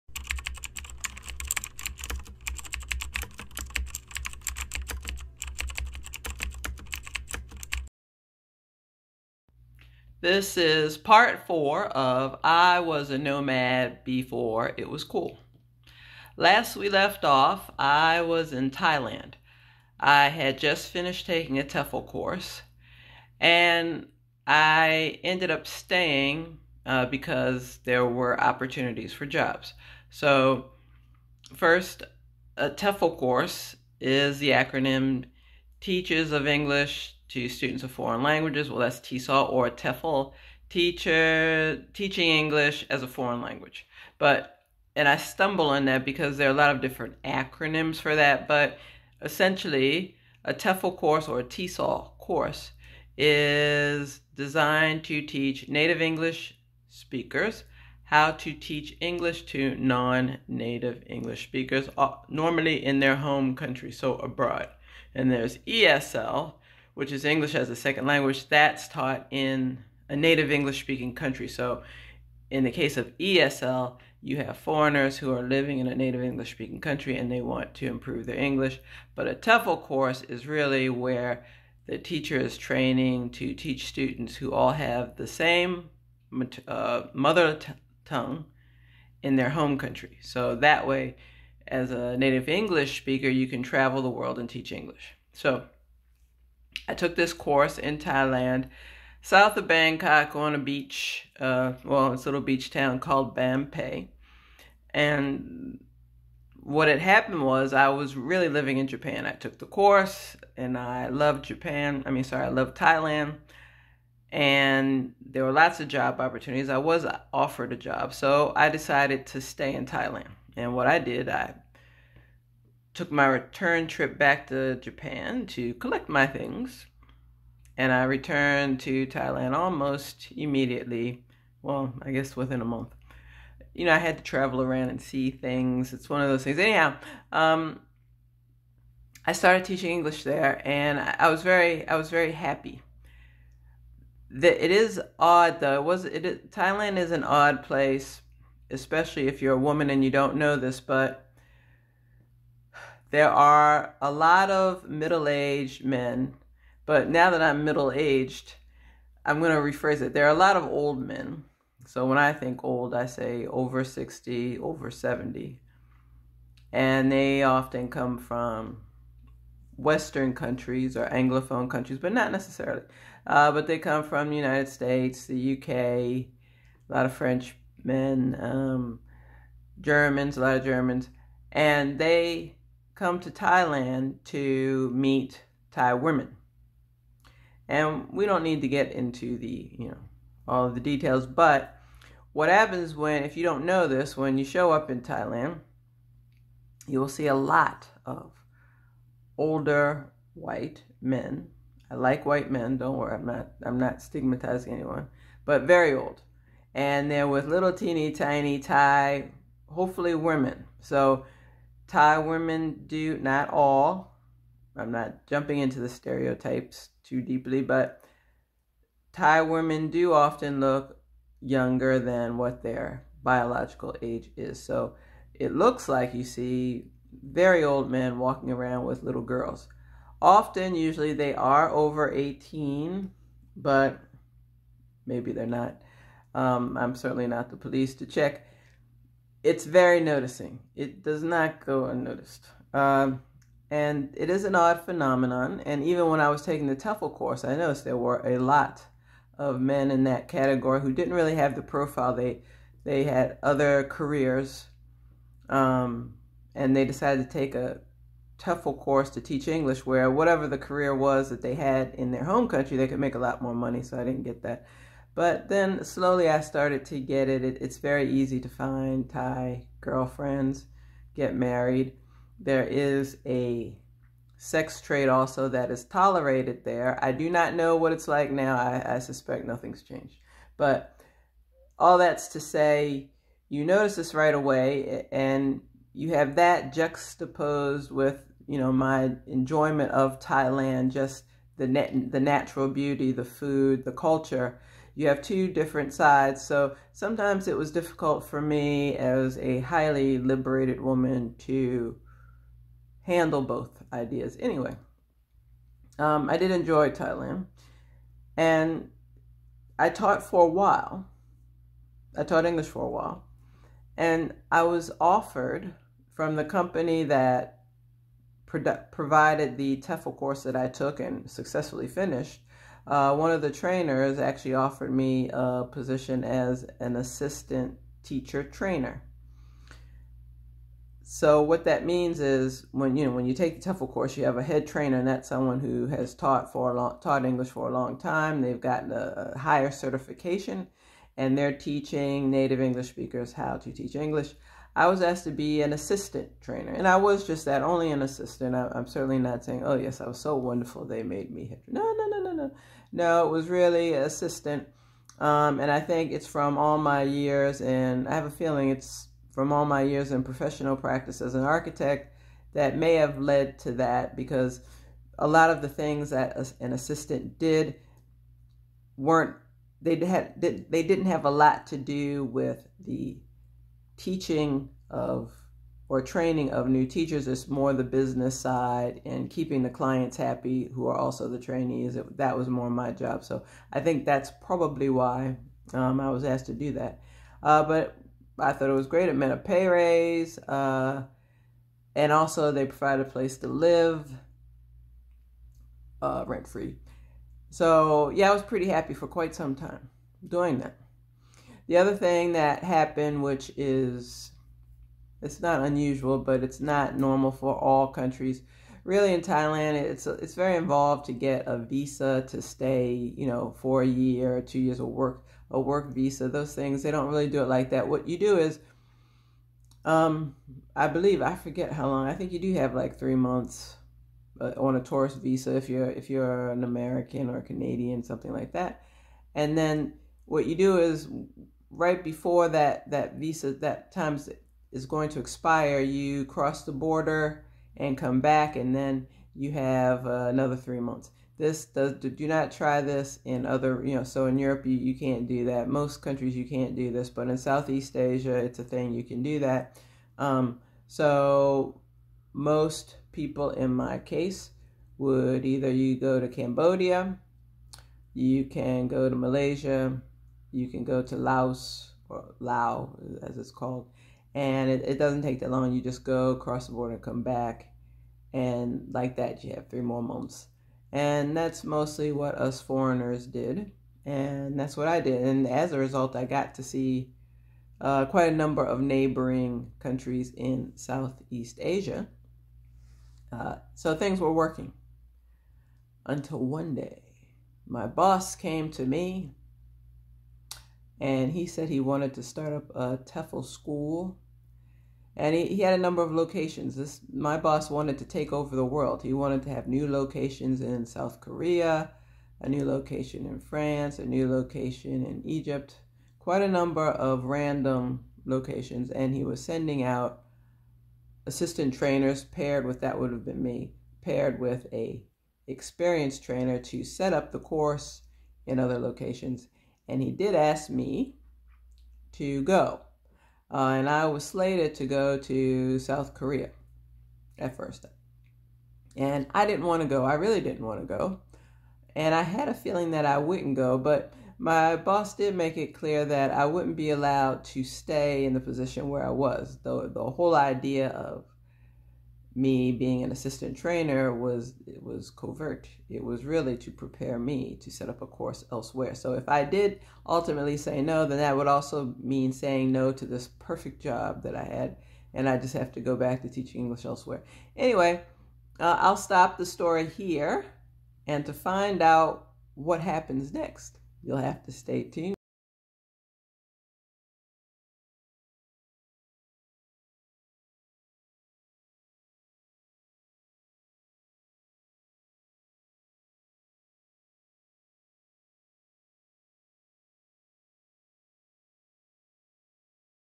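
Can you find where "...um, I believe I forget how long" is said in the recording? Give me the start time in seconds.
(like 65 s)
419 s.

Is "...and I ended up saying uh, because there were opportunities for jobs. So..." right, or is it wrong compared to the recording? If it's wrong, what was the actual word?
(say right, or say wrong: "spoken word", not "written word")
wrong: "staying", not "saying".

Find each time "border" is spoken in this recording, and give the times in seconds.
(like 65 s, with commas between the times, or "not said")
436 s, 466 s.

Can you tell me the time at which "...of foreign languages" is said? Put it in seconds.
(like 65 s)
37 s.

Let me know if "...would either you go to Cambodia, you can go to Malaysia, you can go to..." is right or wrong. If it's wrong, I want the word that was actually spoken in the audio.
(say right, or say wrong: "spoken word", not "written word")
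right.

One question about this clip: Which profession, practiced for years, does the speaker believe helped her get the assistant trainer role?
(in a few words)
architect.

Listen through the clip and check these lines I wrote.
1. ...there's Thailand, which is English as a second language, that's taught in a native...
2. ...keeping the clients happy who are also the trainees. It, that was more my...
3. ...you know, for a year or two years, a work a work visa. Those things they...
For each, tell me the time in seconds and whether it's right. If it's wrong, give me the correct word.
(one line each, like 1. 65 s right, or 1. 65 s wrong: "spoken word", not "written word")
1. 65 s wrong: "ESL", not "Thailand"
2. 379 s right
3. 413 s right.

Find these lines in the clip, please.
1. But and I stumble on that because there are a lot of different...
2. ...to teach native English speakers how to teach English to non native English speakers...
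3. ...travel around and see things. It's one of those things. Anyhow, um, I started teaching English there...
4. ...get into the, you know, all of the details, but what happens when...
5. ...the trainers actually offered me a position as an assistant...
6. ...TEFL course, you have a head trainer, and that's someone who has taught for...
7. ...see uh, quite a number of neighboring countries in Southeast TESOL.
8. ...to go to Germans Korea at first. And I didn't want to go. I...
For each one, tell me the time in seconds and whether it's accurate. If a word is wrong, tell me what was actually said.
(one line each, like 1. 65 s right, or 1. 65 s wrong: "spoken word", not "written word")
1. 44 s right
2. 55 s right
3. 134 s right
4. 188 s right
5. 323 s right
6. 333 s right
7. 476 s wrong: "Asia", not "TESOL"
8. 524 s wrong: "South", not "Germans".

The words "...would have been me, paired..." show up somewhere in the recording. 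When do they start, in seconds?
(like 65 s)
512 s.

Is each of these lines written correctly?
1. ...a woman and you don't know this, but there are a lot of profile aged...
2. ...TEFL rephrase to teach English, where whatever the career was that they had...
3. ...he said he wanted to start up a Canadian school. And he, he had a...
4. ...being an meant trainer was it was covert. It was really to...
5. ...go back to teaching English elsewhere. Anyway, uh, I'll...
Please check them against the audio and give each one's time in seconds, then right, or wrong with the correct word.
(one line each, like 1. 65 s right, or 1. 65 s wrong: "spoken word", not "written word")
1. 149 s wrong: "middle", not "profile"
2. 258 s wrong: "course", not "rephrase"
3. 491 s wrong: "TEFL", not "Canadian"
4. 542 s wrong: "assistant", not "meant"
5. 555 s right.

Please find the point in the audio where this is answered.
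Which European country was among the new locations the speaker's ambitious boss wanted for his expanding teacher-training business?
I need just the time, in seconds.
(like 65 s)
503 s.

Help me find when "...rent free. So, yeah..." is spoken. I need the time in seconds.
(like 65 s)
396 s.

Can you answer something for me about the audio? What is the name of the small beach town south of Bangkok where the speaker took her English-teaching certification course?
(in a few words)
Ban Phe.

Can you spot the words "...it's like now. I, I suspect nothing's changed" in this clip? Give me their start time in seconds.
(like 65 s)
277 s.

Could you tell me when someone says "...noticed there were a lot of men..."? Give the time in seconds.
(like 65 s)
247 s.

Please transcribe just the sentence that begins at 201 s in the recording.
I like white men, don't worry, I'm not I'm not stigmatizing anyone, but very old.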